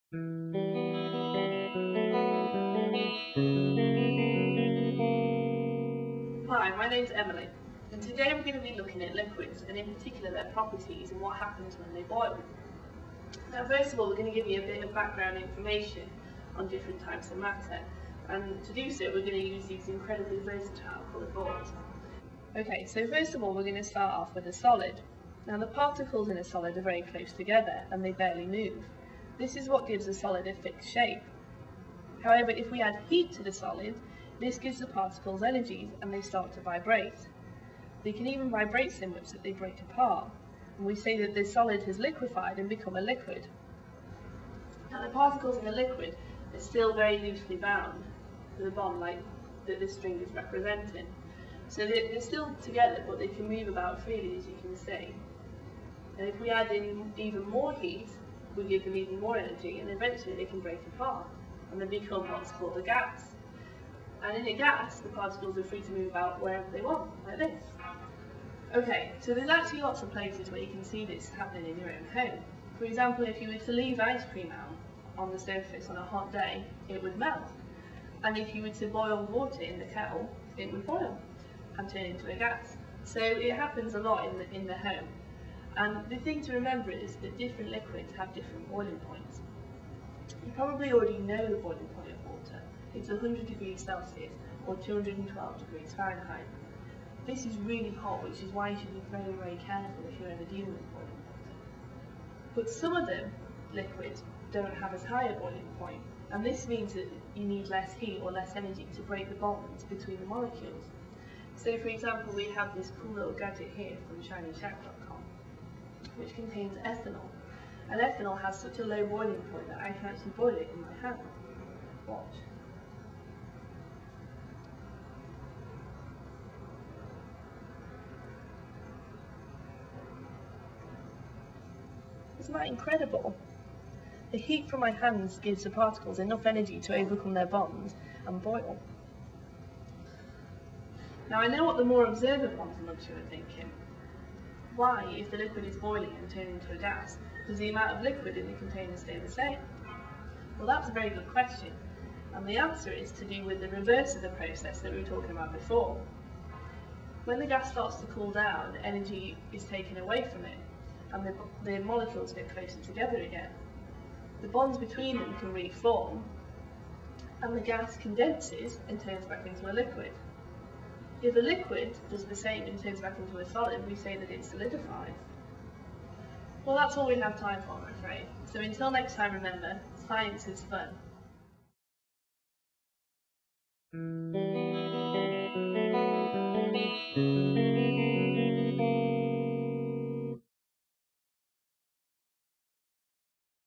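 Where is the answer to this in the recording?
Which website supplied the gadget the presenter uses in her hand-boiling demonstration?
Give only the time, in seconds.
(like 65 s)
114 s.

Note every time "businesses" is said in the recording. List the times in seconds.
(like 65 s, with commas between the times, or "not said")
not said.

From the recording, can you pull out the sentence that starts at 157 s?
When the gas starts to cool down, energy is taken away from it, and the, the molecules get closer together again.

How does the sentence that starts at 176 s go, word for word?
Well, that's all we have time for, I'm afraid.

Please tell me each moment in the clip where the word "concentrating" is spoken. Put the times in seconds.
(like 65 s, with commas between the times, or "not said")
not said.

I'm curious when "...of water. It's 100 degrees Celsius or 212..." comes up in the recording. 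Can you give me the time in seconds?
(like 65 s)
92 s.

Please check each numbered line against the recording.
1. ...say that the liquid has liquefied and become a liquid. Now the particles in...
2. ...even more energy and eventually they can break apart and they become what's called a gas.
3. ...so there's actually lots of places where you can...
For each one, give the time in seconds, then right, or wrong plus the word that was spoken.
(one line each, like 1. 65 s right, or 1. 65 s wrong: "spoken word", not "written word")
1. 40 s wrong: "solid", not "liquid"
2. 58 s right
3. 69 s right.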